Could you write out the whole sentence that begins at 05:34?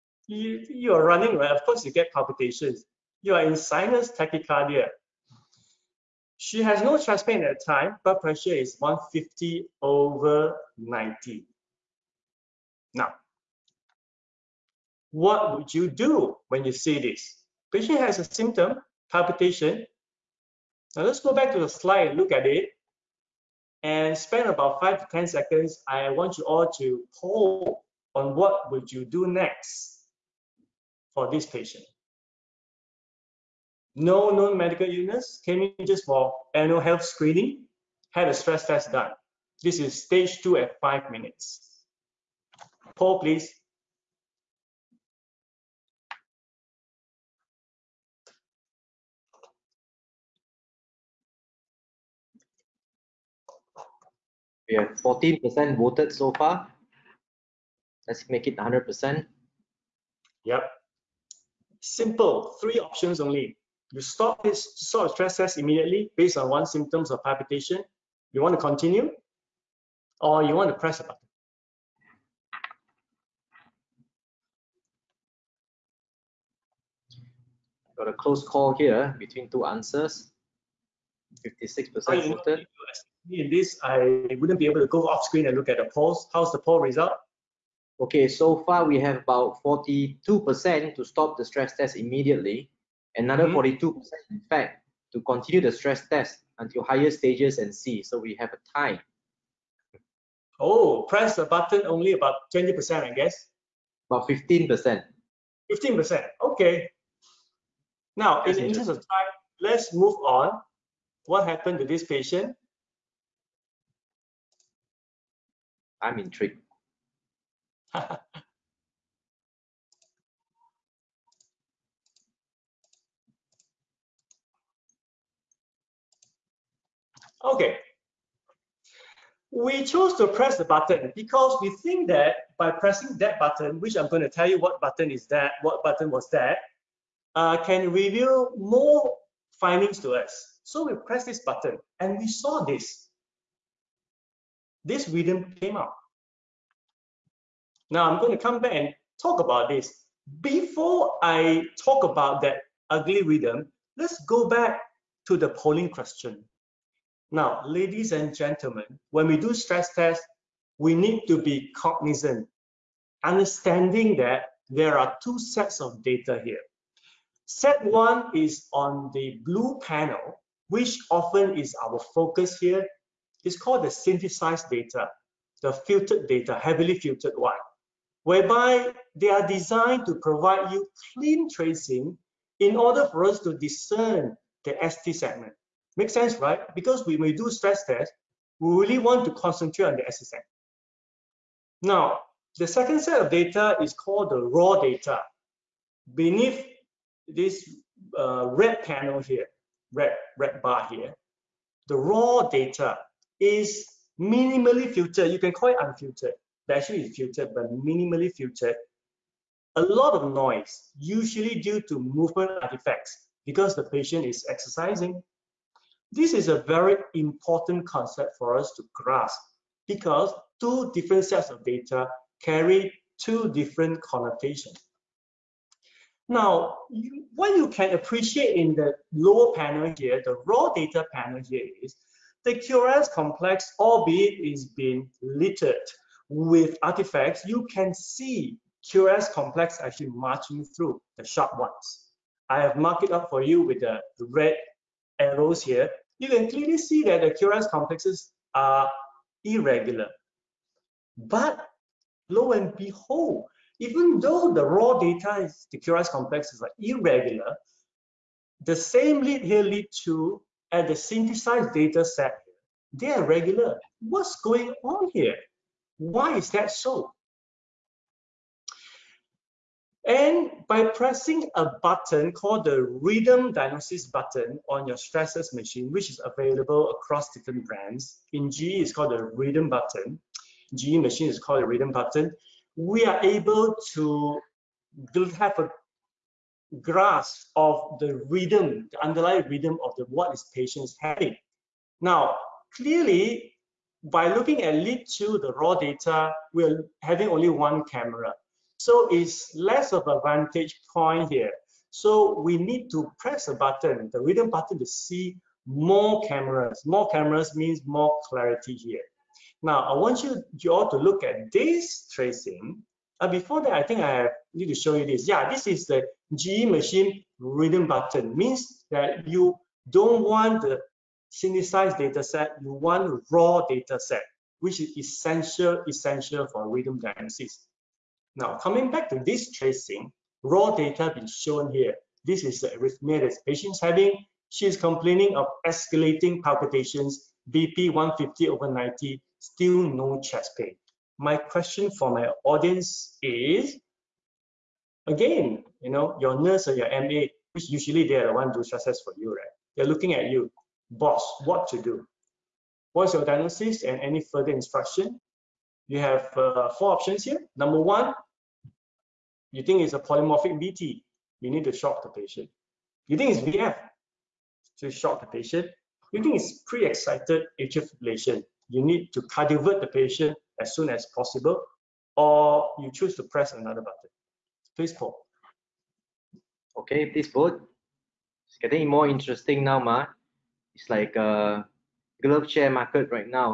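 She is complaining of escalating palpitations, BP 150 over 90, still no chest pain.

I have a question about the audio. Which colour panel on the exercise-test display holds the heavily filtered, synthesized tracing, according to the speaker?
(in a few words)
Blue.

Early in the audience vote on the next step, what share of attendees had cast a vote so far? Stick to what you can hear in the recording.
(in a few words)
14%.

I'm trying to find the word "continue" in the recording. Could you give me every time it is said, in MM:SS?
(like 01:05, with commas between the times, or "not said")
01:08, 01:35.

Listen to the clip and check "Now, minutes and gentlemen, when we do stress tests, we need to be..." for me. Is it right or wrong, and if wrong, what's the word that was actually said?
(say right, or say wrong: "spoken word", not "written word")
wrong: "ladies", not "minutes".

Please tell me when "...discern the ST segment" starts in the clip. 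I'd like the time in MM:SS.
03:03.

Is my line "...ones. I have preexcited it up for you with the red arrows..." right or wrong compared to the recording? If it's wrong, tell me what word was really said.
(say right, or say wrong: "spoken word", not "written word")
wrong: "marked", not "preexcited".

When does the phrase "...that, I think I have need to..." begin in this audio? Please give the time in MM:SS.
05:13.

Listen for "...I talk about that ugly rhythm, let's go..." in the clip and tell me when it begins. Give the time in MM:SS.
02:31.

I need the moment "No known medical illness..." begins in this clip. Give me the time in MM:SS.
00:33.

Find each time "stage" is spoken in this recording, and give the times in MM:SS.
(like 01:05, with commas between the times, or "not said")
00:40, 01:37.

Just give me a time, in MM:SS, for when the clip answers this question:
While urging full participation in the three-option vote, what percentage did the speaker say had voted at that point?
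01:21.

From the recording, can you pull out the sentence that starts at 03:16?
Beneath this uh, red panel here, red, red bar here, the raw data is minimally filtered.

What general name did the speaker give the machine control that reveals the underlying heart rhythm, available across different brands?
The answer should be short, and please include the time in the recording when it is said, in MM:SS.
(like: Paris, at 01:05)
Rhythm Diagnosis button, at 04:32.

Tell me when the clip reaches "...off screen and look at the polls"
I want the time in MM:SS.
01:25.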